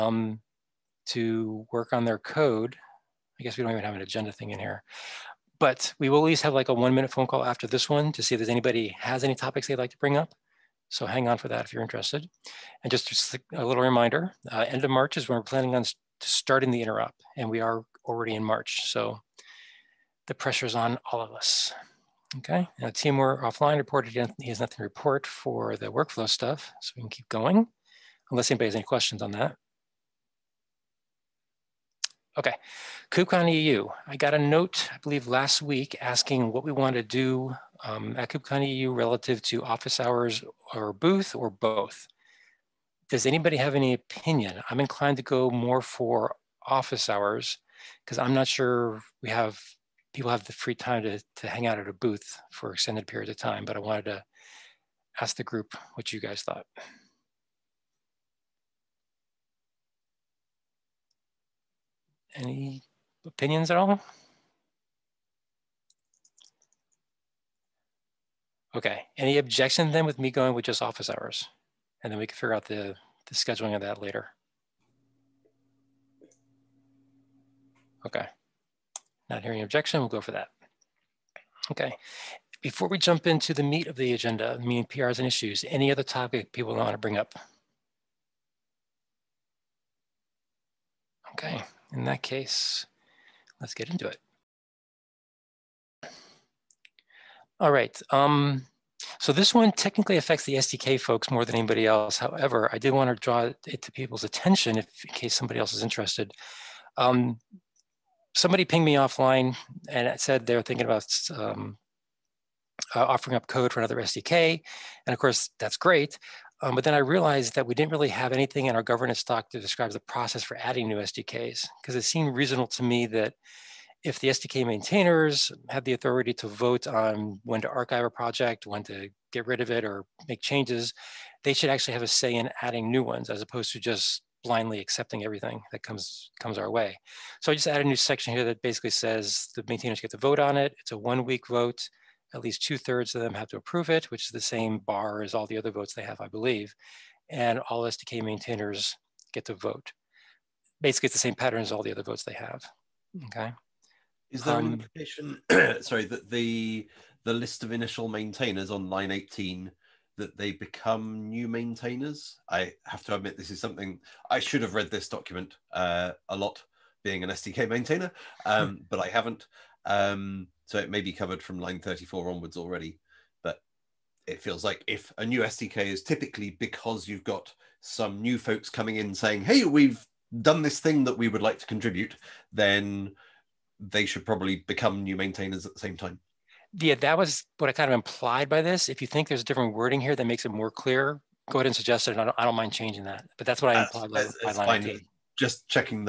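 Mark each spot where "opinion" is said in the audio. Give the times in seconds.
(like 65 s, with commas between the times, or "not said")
43 s, 63 s.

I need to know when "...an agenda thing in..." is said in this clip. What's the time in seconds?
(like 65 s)
3 s.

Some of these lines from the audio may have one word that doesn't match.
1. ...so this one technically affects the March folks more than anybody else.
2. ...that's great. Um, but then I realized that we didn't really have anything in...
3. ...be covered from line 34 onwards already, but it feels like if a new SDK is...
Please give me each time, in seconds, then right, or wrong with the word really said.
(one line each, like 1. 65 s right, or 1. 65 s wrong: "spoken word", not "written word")
1. 99 s wrong: "SDK", not "March"
2. 115 s right
3. 171 s right.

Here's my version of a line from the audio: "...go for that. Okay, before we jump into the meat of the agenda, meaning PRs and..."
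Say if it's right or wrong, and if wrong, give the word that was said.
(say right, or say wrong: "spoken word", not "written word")
right.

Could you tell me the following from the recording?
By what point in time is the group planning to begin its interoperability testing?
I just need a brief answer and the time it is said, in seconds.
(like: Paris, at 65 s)
End of March, at 14 s.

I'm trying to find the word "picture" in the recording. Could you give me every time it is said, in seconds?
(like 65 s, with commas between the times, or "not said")
not said.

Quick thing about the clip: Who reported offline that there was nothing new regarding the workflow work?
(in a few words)
Timur.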